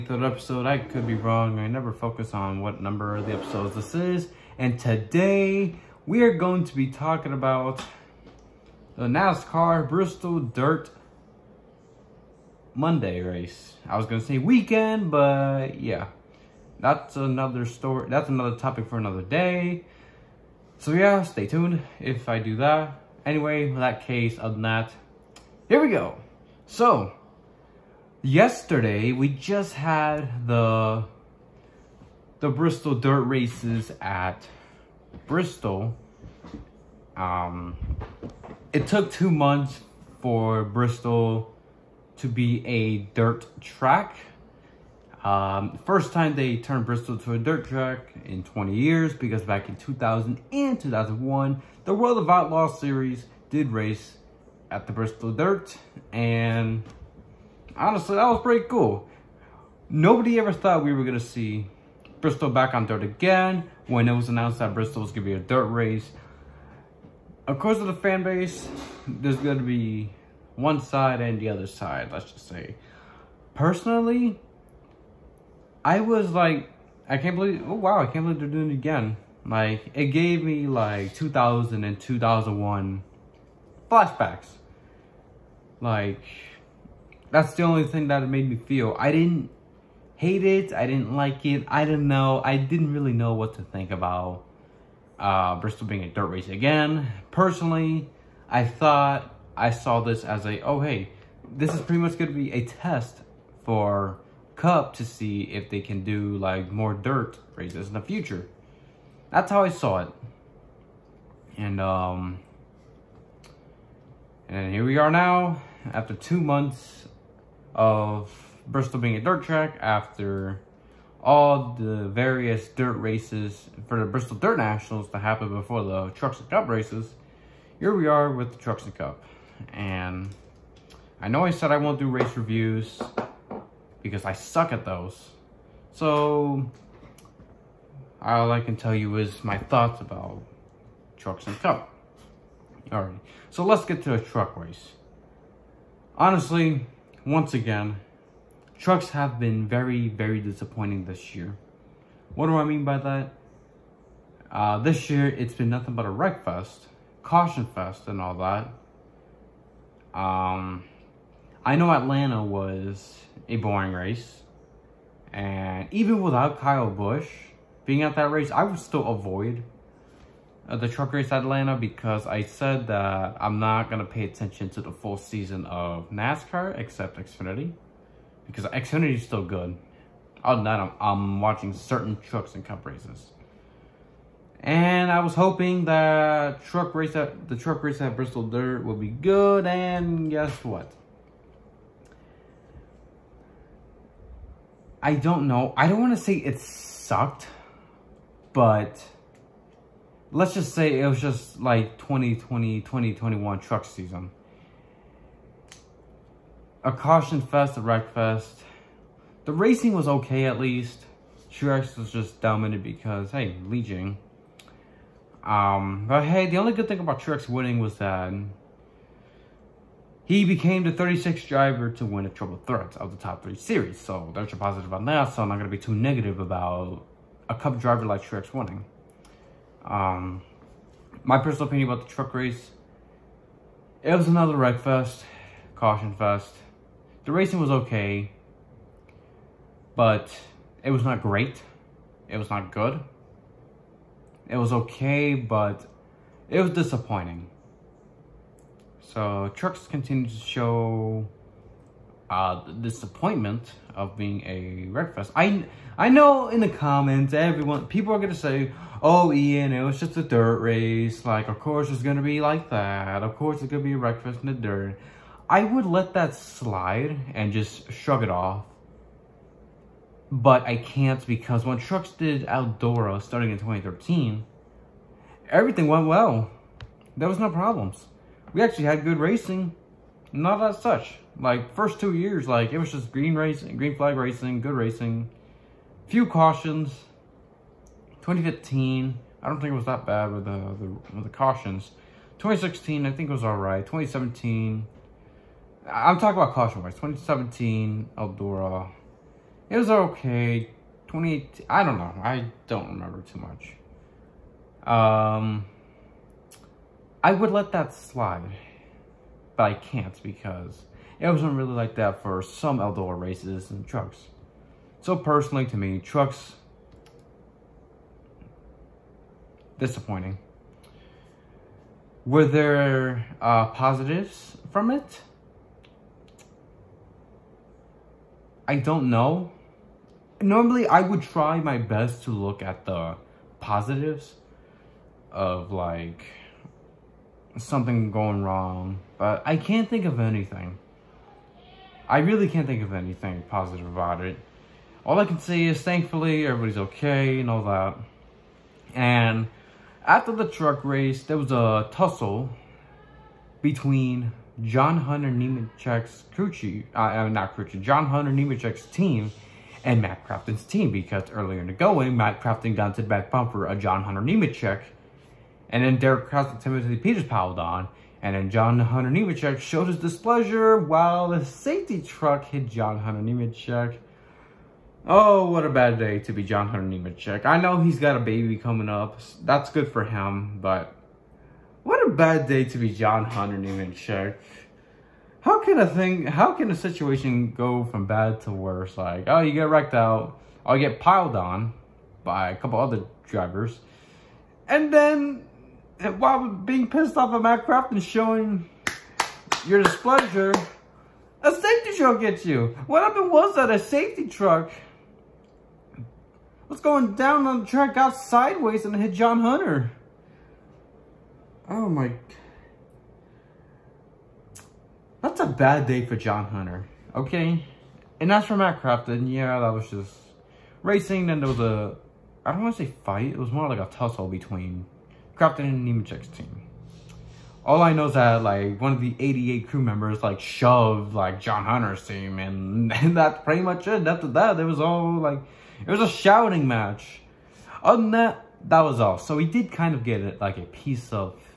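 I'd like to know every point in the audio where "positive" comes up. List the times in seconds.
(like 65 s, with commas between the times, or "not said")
224 s, 323 s, 333 s, 343 s.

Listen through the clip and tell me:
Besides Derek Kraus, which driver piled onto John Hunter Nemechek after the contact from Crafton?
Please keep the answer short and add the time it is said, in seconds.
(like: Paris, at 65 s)
Timothy Peters, at 366 s.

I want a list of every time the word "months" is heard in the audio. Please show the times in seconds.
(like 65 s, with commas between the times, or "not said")
39 s, 116 s.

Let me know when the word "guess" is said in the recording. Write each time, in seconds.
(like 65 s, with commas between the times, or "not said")
190 s.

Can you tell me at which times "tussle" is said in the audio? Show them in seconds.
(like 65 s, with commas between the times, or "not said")
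351 s, 423 s.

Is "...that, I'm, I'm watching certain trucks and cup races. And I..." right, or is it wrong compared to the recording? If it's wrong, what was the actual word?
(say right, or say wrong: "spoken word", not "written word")
right.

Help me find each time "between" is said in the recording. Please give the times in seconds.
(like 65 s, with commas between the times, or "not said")
353 s, 424 s.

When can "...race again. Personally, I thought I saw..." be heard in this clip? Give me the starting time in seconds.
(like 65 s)
96 s.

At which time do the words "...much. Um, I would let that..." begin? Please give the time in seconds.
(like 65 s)
303 s.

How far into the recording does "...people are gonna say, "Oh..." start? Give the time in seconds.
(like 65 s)
257 s.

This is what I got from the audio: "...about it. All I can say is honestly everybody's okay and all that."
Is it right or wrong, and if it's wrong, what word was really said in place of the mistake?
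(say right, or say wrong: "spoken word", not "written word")
wrong: "thankfully", not "honestly".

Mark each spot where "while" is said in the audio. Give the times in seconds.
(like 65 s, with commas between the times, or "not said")
370 s, 396 s.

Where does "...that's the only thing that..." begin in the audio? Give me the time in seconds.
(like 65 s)
87 s.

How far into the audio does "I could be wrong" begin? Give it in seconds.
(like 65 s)
0 s.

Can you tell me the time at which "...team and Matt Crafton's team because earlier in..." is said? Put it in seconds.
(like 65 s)
358 s.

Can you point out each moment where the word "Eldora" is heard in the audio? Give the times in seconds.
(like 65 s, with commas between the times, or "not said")
272 s, 298 s, 312 s.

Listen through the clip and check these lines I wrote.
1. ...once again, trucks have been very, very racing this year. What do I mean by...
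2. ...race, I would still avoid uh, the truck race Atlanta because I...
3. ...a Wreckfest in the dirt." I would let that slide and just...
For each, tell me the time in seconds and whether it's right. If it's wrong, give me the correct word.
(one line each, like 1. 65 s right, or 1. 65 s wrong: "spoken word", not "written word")
1. 147 s wrong: "disappointing", not "racing"
2. 168 s right
3. 263 s right.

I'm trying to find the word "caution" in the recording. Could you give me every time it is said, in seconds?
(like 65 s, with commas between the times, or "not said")
157 s, 206 s, 235 s, 286 s, 291 s, 296 s.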